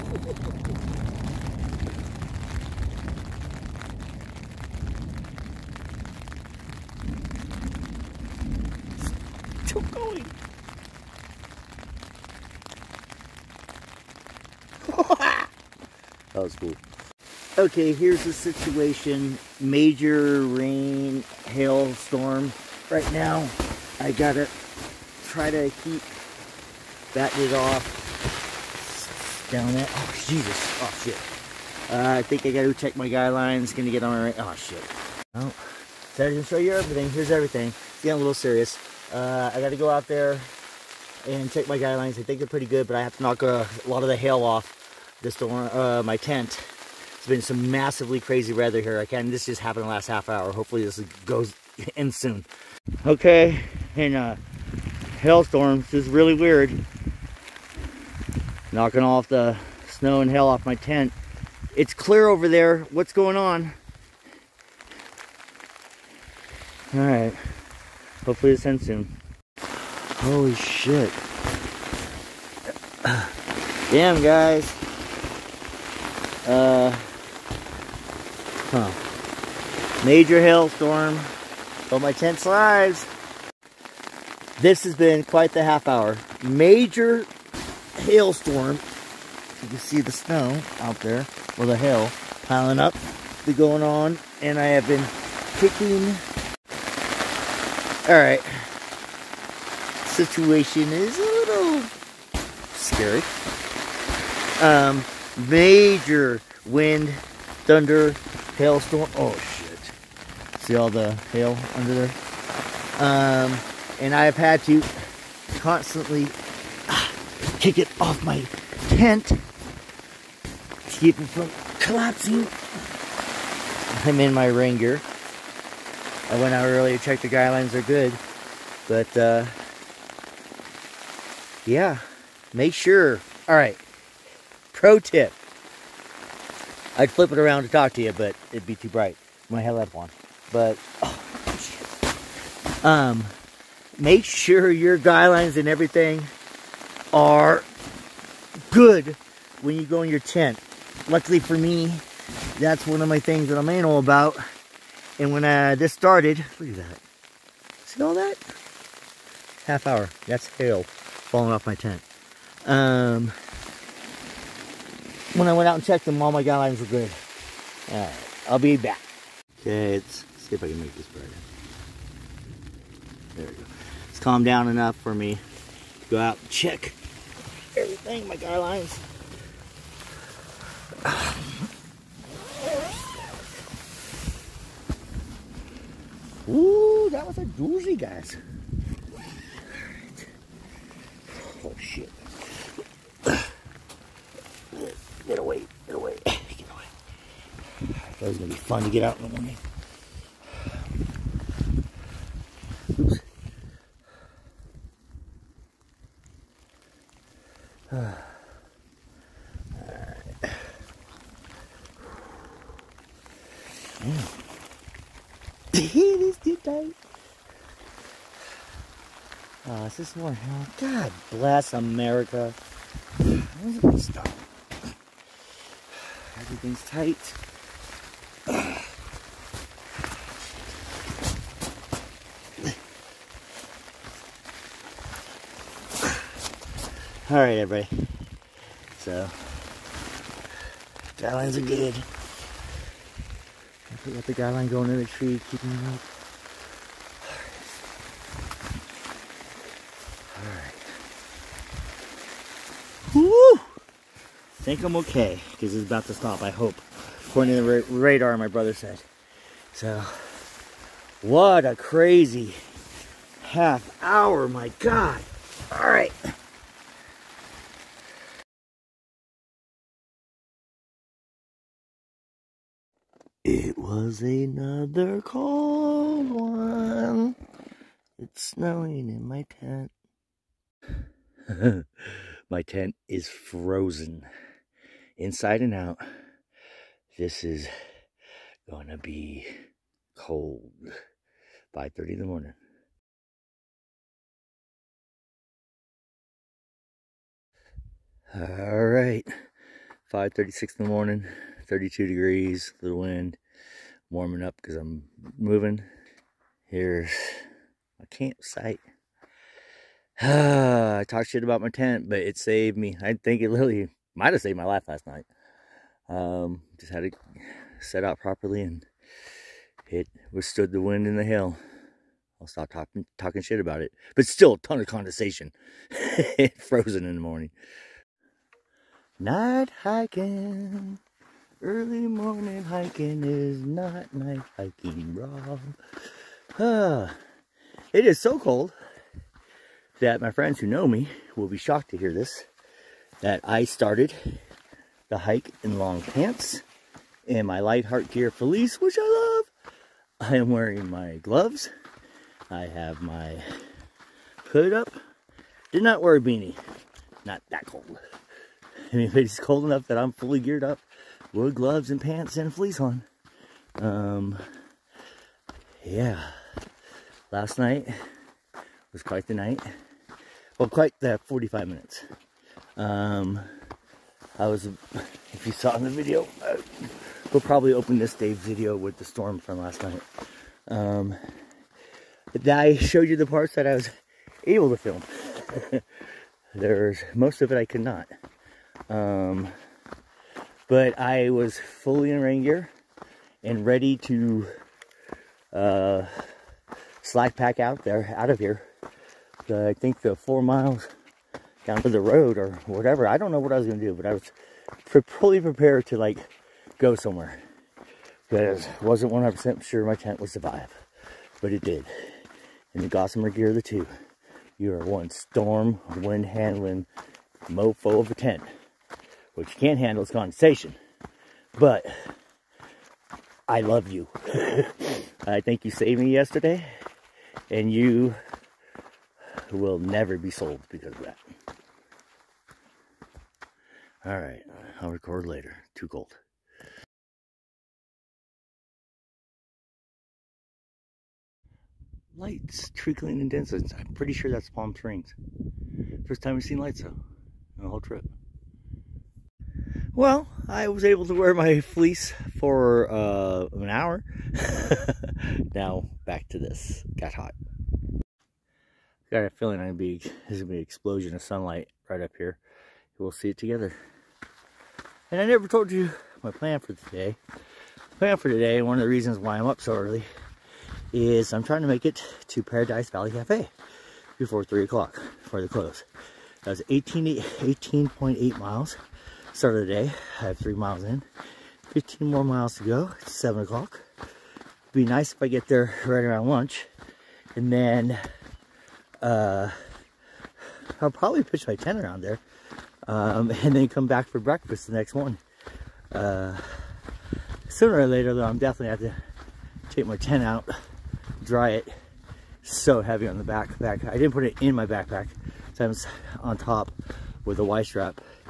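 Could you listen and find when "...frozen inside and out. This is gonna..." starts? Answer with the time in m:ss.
4:43.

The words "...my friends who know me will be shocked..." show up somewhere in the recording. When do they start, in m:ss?
5:40.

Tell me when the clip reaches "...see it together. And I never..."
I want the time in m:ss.
7:43.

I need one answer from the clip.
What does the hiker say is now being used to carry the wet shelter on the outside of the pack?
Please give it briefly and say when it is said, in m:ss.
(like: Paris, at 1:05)
Y-strap, at 8:27.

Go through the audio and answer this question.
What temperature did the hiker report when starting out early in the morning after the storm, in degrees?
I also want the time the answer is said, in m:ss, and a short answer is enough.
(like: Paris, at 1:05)
32, at 5:01.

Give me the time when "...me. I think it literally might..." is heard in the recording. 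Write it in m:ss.
5:12.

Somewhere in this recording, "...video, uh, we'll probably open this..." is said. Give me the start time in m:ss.
6:15.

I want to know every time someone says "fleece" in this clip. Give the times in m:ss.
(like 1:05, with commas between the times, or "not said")
5:48, 6:02, 7:31.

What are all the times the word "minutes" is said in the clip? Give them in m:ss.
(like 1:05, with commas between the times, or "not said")
6:11.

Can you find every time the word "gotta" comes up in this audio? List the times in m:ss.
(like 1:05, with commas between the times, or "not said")
0:24, 0:32, 0:39.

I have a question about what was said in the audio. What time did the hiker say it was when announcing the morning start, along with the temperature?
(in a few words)
5:36.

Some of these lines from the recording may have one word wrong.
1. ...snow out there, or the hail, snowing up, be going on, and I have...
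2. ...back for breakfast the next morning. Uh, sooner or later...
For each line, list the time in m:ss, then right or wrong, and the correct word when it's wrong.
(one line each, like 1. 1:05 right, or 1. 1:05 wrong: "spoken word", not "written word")
1. 1:30 wrong: "piling", not "snowing"
2. 8:13 right.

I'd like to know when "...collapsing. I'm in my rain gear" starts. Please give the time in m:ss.
2:01.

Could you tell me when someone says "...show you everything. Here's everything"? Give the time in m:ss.
0:36.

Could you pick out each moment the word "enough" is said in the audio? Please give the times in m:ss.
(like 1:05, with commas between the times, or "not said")
2:54, 5:59.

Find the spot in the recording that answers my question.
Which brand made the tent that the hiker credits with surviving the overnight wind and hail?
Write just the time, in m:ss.
6:52.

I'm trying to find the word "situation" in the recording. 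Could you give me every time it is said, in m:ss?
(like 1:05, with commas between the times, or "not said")
0:18, 1:40.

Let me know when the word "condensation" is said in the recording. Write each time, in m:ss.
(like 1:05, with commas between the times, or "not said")
5:24, 7:00.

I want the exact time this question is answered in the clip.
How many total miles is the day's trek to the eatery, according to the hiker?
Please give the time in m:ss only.
7:56.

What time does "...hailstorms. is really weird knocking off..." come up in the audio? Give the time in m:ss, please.
0:55.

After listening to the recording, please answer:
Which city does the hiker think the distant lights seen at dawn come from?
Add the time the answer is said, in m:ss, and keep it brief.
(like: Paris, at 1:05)
Palm Springs, at 7:24.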